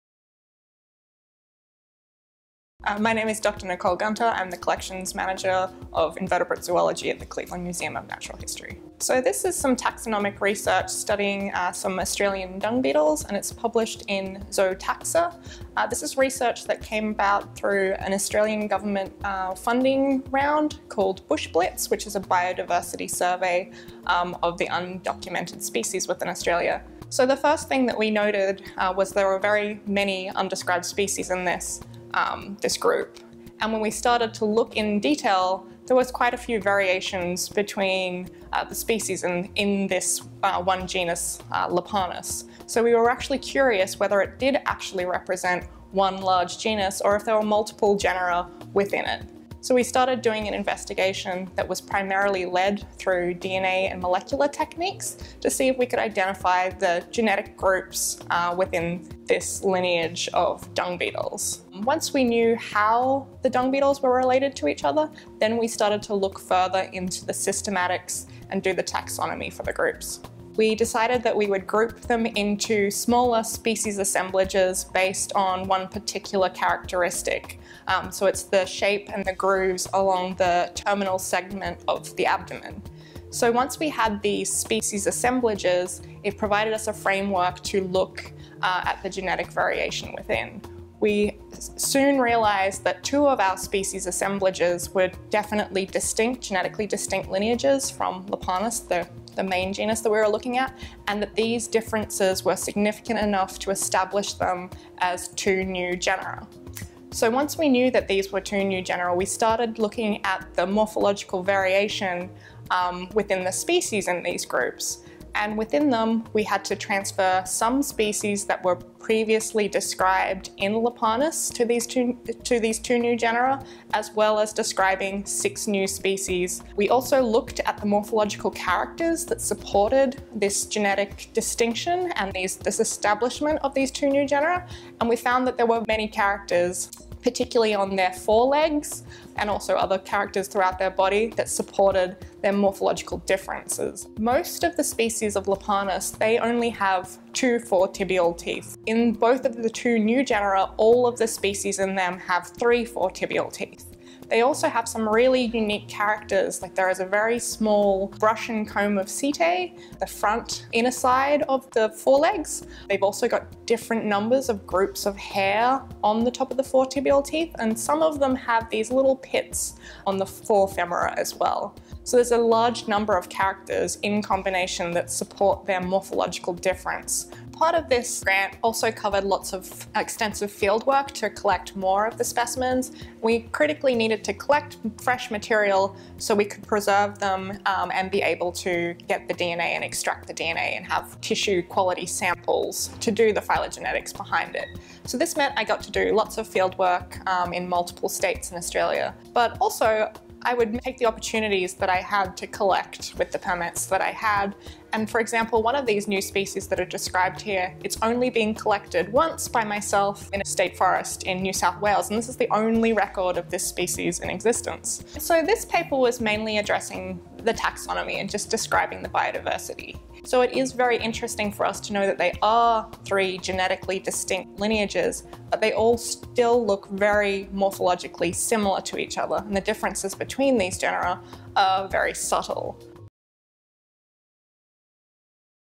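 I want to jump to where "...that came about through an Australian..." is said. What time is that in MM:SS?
00:16.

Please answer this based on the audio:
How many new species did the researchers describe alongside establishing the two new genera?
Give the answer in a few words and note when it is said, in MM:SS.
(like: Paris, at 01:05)
6, at 02:05.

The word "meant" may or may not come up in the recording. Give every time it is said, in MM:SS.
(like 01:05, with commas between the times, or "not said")
03:15.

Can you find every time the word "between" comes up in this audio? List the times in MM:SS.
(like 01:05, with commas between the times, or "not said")
00:37, 03:50.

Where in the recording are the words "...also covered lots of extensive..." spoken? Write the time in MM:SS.
02:58.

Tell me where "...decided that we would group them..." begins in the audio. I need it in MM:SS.
01:10.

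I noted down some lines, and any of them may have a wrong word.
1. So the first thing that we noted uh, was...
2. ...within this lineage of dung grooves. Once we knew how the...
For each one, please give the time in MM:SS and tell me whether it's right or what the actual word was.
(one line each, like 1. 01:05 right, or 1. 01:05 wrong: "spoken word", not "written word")
1. 00:27 right
2. 00:58 wrong: "beetles", not "grooves".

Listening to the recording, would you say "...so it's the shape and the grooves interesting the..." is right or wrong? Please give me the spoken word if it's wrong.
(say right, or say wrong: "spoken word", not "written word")
wrong: "along", not "interesting".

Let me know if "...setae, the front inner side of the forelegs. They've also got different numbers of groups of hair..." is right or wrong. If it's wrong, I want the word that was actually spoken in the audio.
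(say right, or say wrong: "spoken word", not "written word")
right.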